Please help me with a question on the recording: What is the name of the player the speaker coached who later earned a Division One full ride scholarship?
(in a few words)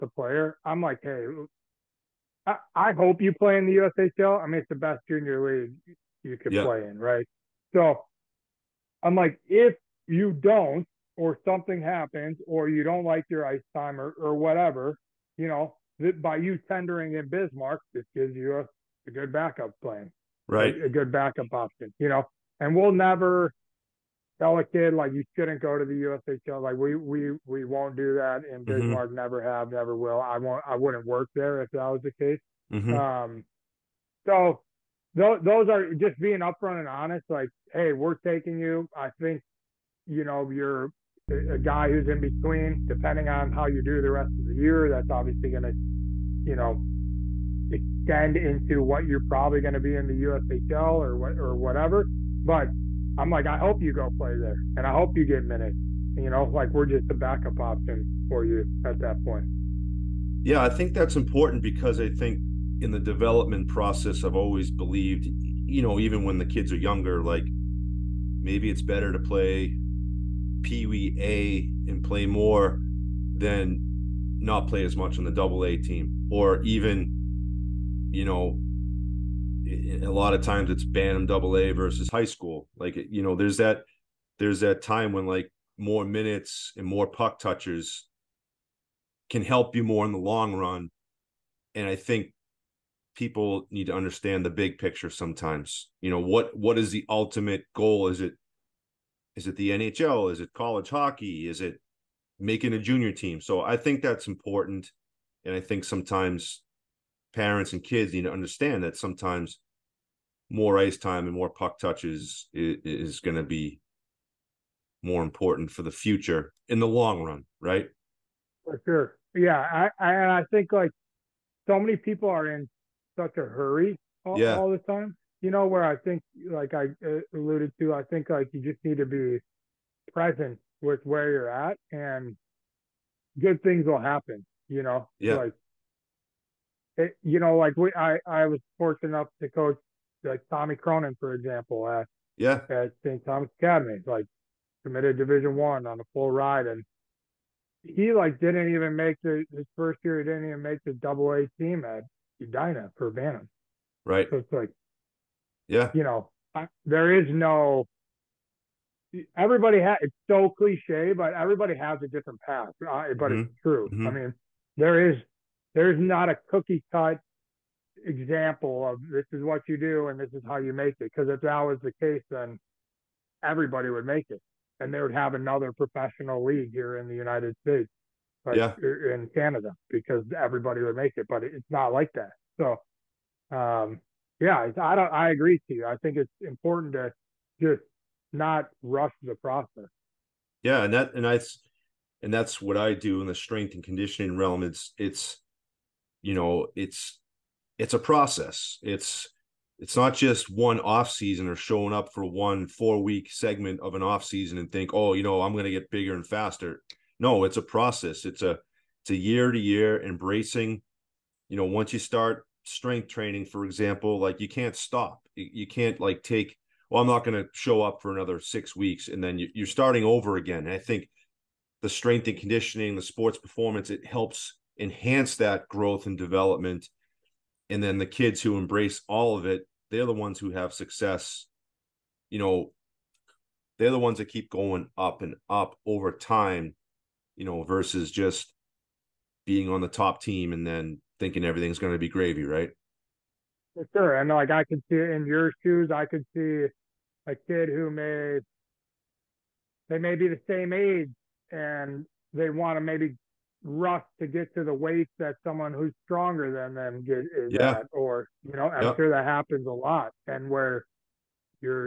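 Tommy Cronin.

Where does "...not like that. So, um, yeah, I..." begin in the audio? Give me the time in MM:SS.
03:01.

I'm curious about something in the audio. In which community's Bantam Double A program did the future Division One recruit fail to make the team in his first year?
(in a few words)
Edina.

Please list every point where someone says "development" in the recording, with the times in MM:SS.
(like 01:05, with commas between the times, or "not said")
01:02, 03:46.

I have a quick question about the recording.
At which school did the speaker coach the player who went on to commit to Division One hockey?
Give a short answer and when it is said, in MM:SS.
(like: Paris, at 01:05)
St. Thomas Academy, at 02:23.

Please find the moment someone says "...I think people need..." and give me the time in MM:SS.
01:31.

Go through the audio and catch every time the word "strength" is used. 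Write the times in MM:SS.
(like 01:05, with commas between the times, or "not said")
03:13, 03:32, 03:41.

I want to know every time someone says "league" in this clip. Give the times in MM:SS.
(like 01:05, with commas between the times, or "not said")
00:05, 02:56.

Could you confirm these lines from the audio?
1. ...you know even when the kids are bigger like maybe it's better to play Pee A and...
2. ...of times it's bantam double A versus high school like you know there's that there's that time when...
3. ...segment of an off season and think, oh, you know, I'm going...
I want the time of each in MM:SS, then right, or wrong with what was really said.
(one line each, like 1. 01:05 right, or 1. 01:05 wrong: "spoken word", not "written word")
1. 01:05 wrong: "younger", not "bigger"
2. 01:20 right
3. 03:23 right.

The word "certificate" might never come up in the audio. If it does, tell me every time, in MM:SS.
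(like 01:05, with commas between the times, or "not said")
not said.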